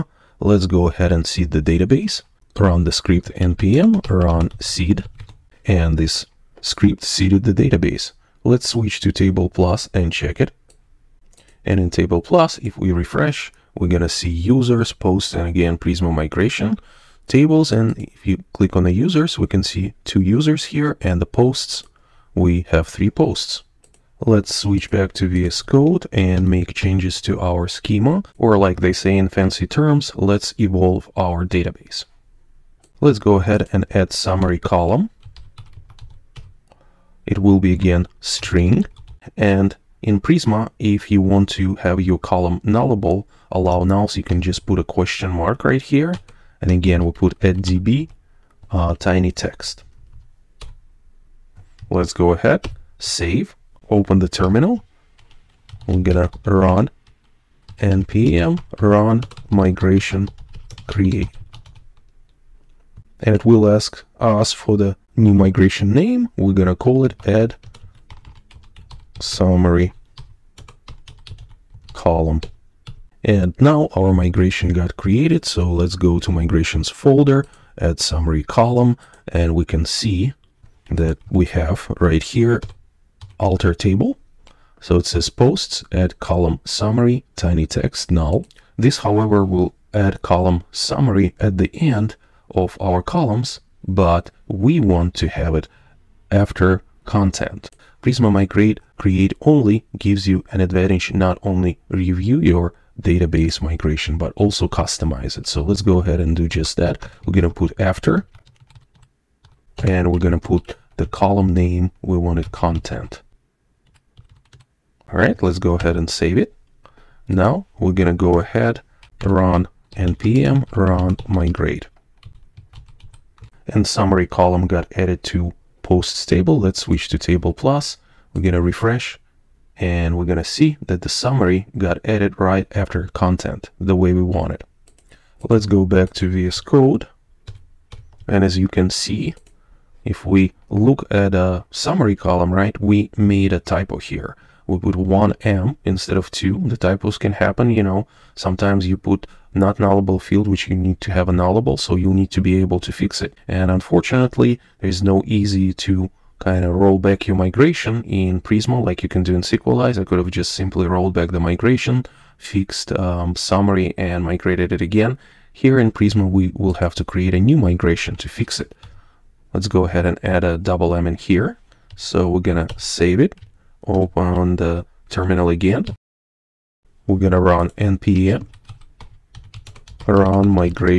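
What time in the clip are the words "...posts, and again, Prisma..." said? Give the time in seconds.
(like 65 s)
14 s.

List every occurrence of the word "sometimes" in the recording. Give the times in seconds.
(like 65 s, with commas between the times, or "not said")
148 s.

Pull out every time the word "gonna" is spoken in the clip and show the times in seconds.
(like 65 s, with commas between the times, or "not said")
55 s, 66 s, 172 s, 177 s.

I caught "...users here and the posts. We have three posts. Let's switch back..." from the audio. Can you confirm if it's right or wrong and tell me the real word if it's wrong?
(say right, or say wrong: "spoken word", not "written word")
right.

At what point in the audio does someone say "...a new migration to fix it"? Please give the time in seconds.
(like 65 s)
167 s.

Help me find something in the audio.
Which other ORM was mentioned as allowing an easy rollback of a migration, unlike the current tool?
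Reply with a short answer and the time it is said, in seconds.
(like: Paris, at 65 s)
Sequelize, at 159 s.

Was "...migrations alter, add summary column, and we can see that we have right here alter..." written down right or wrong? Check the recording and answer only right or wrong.
wrong.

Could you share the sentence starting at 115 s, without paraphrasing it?
All right, let's go ahead and save it.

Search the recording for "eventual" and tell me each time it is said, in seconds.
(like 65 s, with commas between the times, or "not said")
not said.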